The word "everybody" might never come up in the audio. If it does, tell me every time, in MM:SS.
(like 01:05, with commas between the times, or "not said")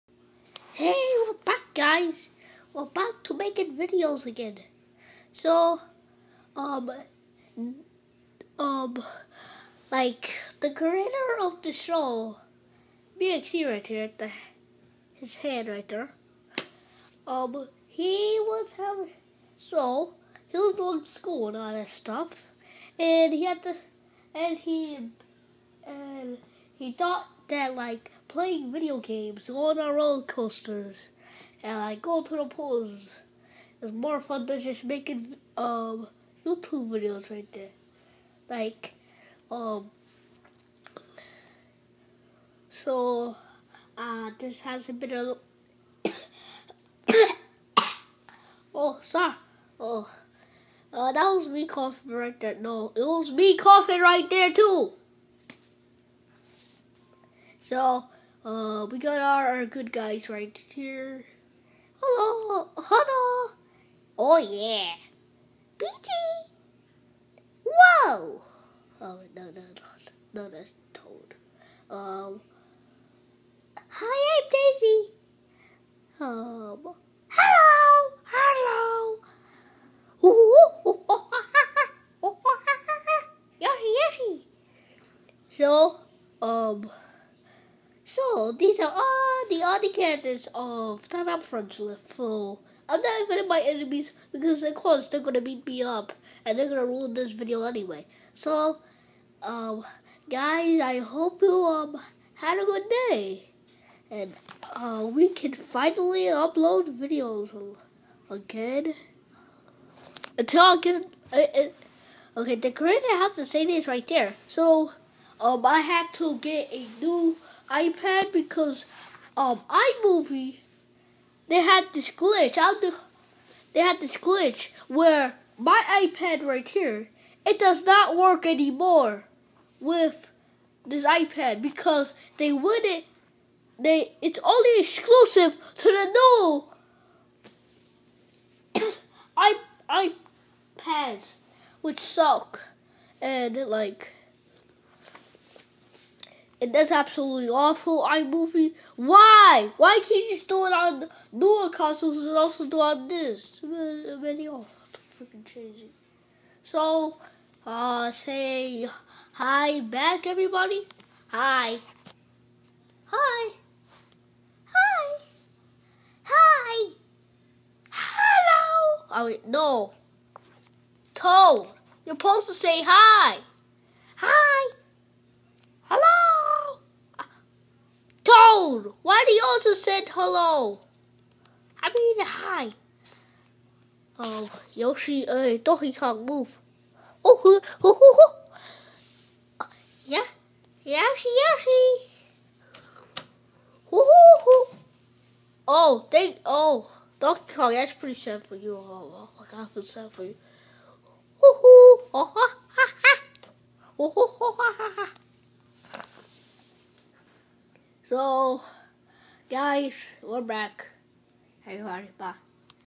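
02:40, 03:31.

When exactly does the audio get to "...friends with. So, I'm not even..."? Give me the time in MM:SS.
01:31.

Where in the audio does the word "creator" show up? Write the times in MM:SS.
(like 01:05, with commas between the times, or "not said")
00:10, 01:52.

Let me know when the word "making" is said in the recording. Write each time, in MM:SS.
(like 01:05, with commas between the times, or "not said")
00:03, 00:34.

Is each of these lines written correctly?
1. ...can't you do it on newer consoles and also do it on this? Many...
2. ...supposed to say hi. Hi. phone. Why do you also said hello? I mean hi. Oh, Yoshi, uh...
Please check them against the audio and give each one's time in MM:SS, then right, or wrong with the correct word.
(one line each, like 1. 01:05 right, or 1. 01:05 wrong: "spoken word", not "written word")
1. 02:30 right
2. 02:52 right.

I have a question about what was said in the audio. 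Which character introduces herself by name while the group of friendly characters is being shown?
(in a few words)
Daisy.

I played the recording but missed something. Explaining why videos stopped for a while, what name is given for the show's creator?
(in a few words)
BXD.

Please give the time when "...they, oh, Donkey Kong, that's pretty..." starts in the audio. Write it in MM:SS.
03:16.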